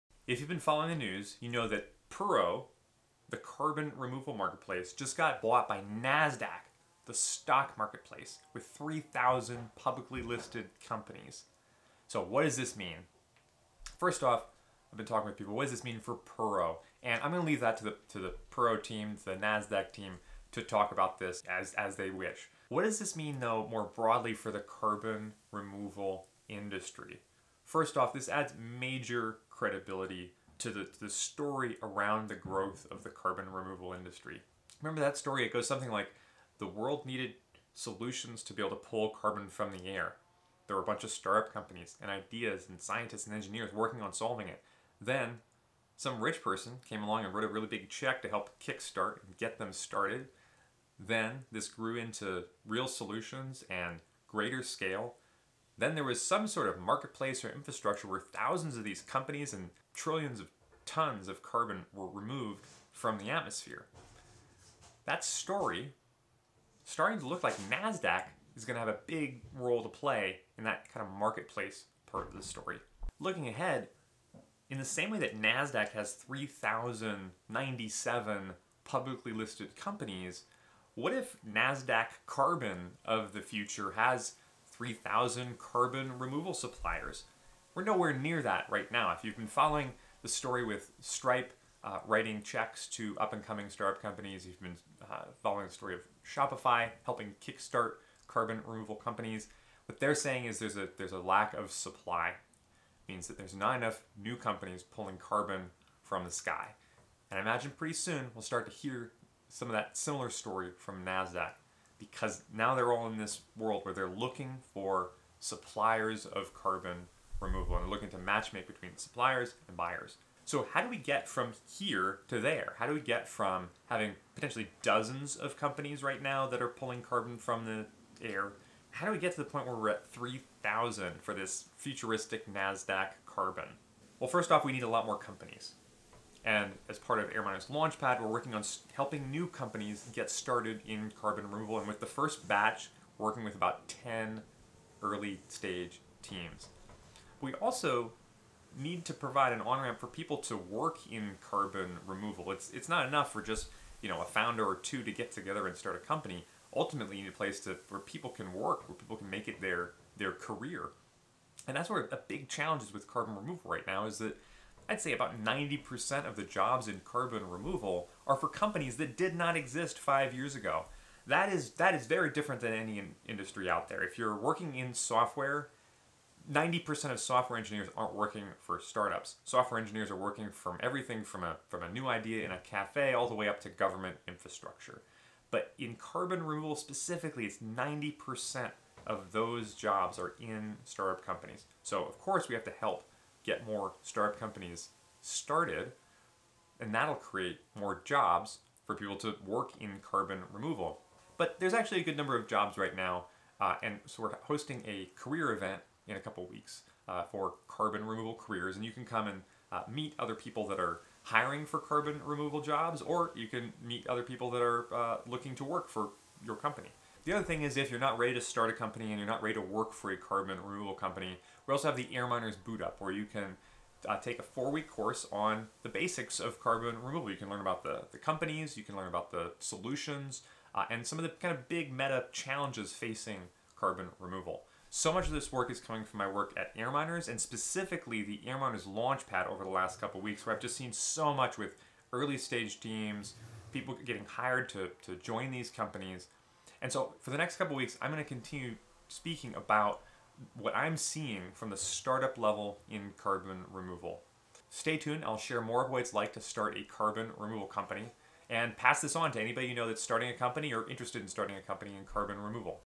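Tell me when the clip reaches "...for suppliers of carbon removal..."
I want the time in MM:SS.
01:54.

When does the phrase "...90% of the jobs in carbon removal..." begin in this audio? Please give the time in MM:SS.
02:45.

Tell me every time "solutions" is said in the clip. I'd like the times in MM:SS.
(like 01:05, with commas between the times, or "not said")
00:37, 00:52, 03:49.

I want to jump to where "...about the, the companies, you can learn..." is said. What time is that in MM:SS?
03:47.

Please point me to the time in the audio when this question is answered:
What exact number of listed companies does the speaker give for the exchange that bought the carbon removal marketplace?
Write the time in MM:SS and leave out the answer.
01:16.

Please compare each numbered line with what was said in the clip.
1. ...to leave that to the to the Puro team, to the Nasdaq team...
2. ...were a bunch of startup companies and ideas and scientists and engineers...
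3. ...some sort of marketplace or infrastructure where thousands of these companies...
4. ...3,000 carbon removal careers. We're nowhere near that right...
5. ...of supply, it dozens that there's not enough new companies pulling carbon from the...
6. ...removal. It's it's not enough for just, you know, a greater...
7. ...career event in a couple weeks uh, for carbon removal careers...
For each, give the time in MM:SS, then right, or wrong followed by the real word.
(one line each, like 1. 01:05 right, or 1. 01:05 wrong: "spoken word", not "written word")
1. 00:17 right
2. 00:40 right
3. 00:56 right
4. 01:24 wrong: "suppliers", not "careers"
5. 01:41 wrong: "means", not "dozens"
6. 02:32 wrong: "founder", not "greater"
7. 03:25 right.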